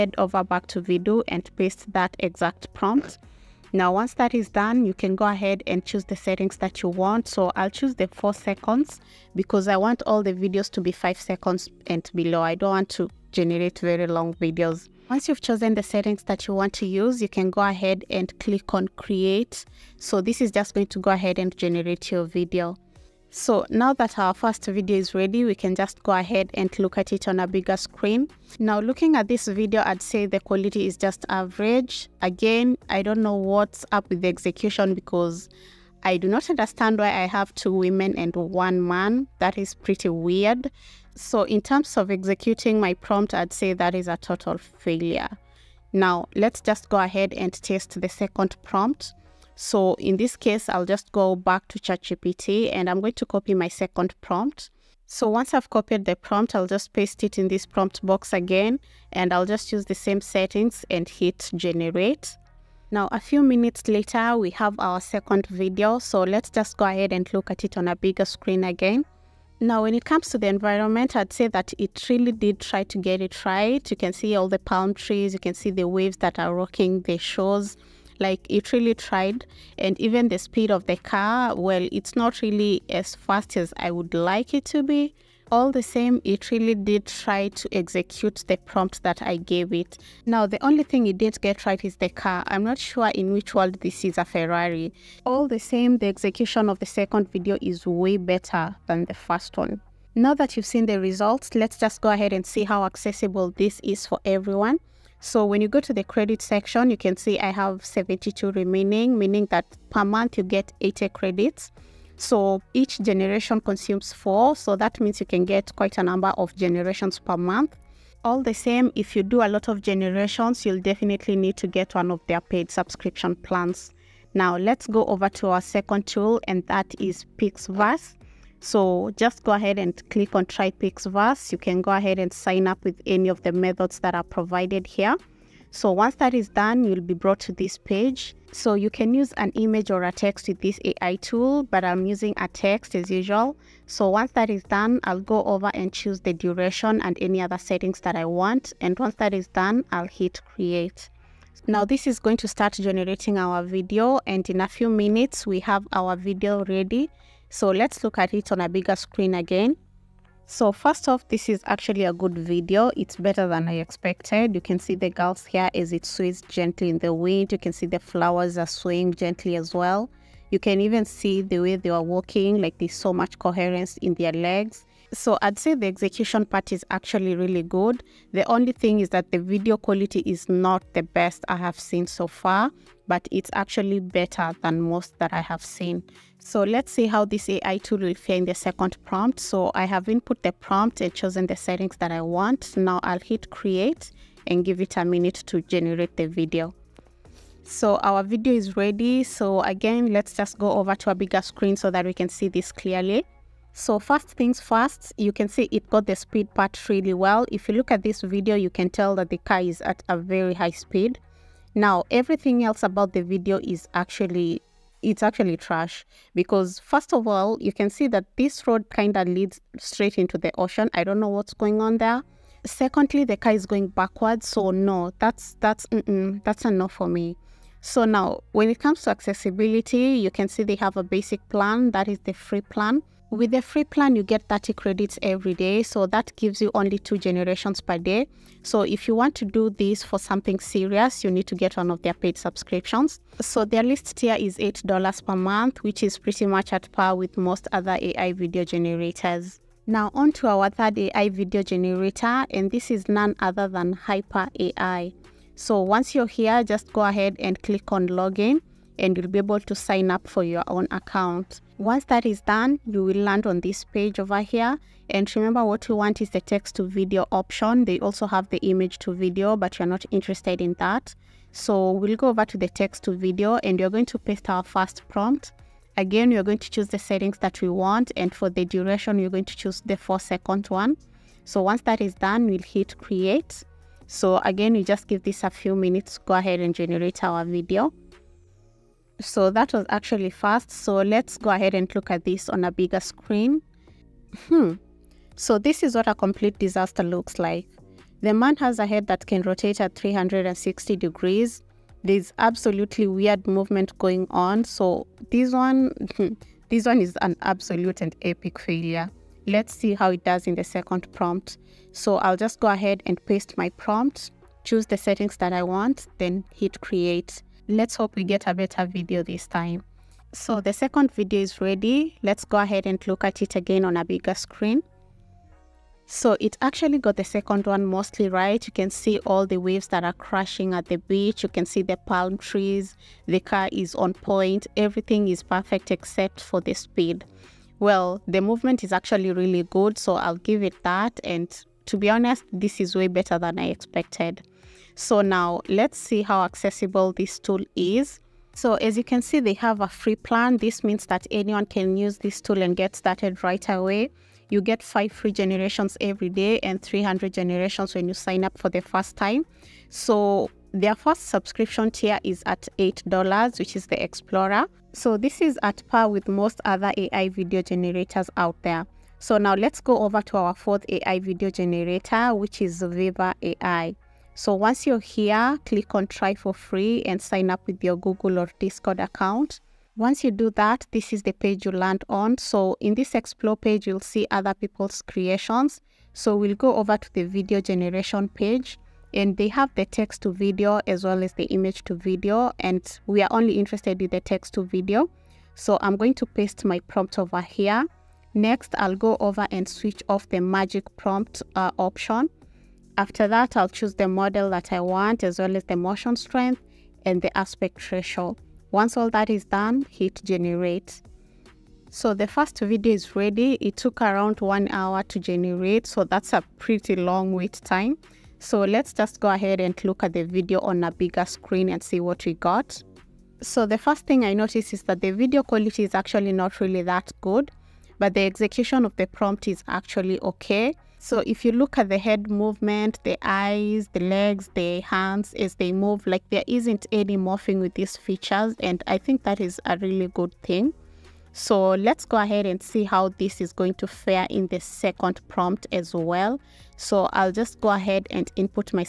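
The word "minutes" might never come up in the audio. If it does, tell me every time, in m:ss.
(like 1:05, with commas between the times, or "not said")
1:03, 2:34, 3:15, 4:45.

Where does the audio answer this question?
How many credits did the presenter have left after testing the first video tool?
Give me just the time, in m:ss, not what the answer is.
1:47.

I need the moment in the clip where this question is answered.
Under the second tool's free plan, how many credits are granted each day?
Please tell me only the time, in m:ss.
3:54.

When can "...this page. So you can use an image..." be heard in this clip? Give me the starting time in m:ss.
2:17.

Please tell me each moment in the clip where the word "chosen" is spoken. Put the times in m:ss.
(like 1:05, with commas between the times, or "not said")
0:15, 3:11.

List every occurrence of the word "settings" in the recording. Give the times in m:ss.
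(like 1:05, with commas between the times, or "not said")
0:06, 0:15, 1:00, 2:27, 3:11, 4:36, 5:14.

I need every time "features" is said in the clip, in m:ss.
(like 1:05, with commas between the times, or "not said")
7:17.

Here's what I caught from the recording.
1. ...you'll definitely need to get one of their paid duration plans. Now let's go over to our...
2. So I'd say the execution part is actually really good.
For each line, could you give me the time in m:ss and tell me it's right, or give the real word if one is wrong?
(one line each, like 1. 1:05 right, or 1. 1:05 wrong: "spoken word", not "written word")
1. 2:00 wrong: "subscription", not "duration"
2. 2:55 right.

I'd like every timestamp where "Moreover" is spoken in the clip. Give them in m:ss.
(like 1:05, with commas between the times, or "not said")
not said.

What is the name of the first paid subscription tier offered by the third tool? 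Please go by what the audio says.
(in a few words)
Explorer.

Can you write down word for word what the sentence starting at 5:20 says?
So the second video is ready.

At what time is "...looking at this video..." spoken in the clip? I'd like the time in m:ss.
0:28.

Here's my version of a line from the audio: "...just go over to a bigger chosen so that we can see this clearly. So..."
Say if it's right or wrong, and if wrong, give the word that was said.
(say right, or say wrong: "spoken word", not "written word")
wrong: "screen", not "chosen".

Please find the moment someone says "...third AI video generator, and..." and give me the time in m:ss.
4:10.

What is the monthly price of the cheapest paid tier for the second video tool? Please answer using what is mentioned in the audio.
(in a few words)
$8.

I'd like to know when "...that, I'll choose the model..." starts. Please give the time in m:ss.
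6:43.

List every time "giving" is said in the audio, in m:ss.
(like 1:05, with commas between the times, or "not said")
not said.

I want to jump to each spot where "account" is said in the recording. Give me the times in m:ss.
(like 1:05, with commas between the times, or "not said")
4:20, 6:18.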